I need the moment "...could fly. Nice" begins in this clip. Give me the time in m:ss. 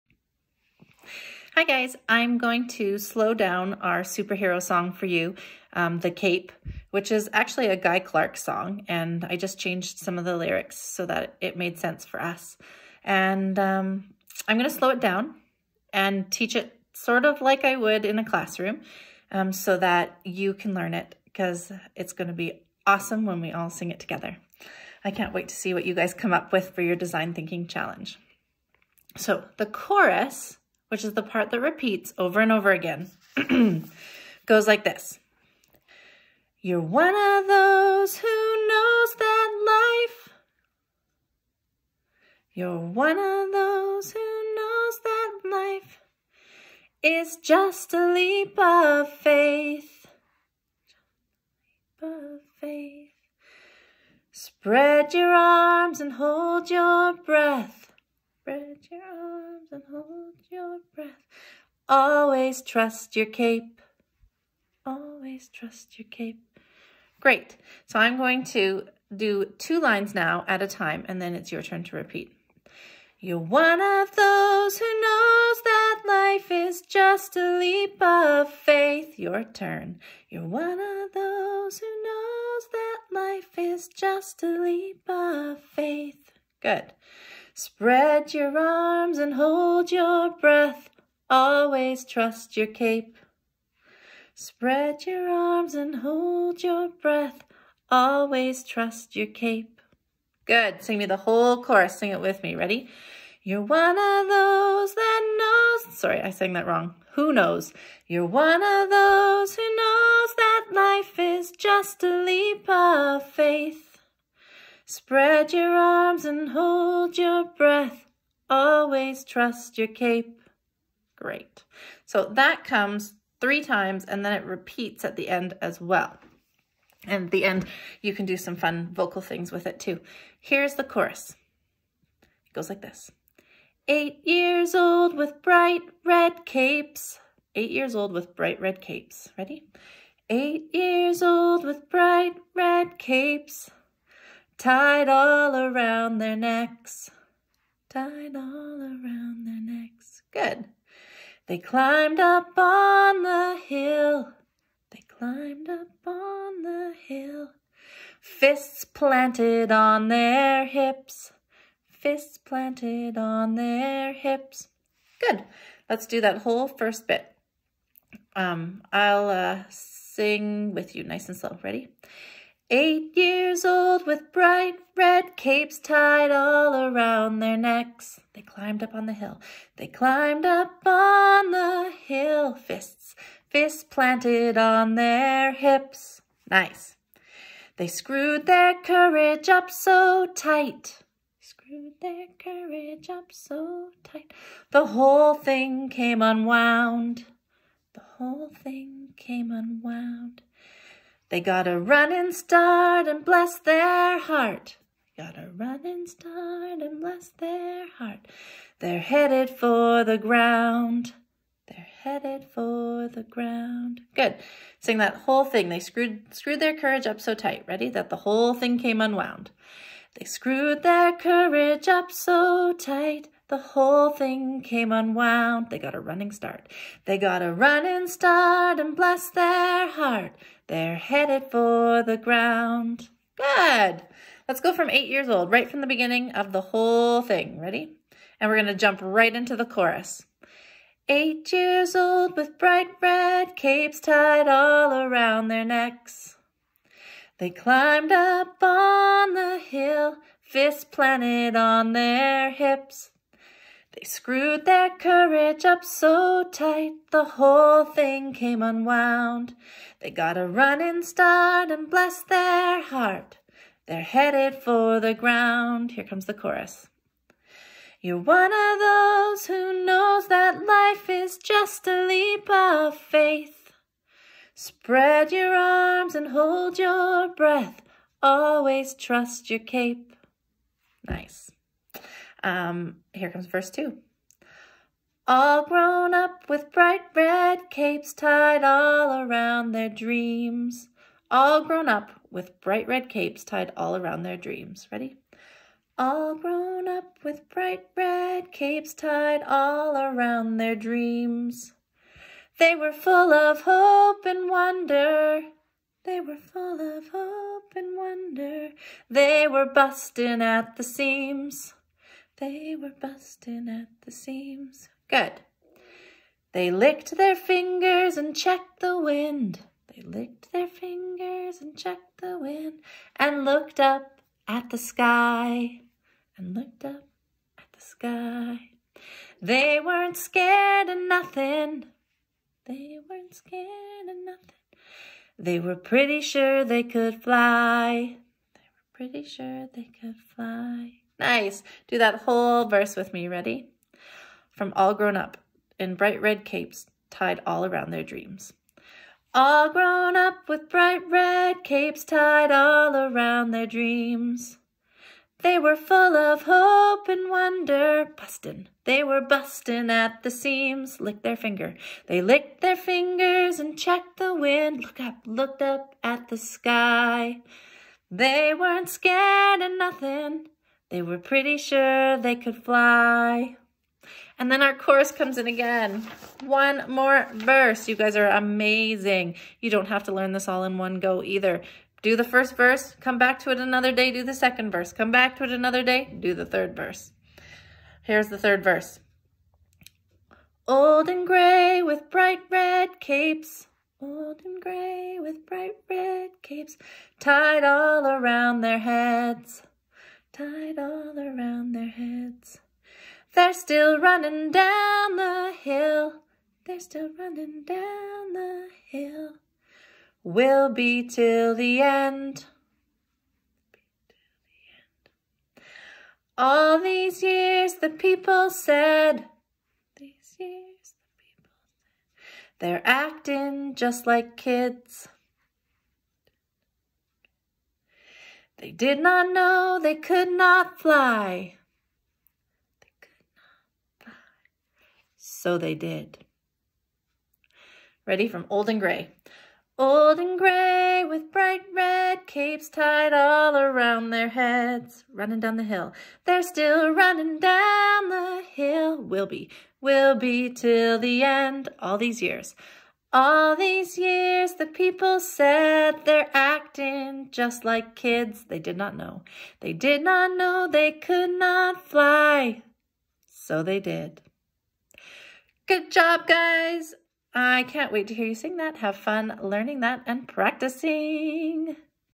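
5:40.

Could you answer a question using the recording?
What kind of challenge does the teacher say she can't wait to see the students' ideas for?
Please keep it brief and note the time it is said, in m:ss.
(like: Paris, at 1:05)
design thinking challenge, at 0:26.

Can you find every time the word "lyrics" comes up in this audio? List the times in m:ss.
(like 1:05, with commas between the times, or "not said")
0:10.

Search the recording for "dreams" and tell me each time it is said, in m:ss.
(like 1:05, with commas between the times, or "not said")
4:49, 4:54, 5:00, 5:48, 5:53.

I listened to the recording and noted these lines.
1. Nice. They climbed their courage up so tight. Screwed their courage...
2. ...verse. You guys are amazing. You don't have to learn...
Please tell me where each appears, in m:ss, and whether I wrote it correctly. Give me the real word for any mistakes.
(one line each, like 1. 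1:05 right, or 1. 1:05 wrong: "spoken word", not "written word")
1. 3:06 wrong: "screwed", not "climbed"
2. 6:17 right.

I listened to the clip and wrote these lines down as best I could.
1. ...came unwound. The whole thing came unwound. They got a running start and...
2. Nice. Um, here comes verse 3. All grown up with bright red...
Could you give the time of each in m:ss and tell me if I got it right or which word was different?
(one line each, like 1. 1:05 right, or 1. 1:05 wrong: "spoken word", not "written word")
1. 3:15 right
2. 4:41 wrong: "2", not "3".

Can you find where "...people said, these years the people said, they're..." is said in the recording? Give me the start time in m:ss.
6:57.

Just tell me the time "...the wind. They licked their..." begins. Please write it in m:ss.
5:18.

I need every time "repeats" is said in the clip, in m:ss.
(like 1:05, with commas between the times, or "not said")
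0:31, 1:11, 2:04.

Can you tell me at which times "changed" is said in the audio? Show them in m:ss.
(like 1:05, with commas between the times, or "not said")
0:09.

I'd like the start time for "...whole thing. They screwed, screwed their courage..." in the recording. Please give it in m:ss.
3:35.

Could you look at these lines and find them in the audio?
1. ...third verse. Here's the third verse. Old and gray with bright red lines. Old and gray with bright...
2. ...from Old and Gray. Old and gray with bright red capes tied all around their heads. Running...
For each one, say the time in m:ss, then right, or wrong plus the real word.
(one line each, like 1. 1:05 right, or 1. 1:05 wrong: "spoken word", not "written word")
1. 6:26 wrong: "capes", not "lines"
2. 7:18 right.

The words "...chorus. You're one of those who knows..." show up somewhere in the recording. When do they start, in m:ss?
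4:26.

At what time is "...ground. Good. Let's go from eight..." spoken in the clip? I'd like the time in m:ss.
3:52.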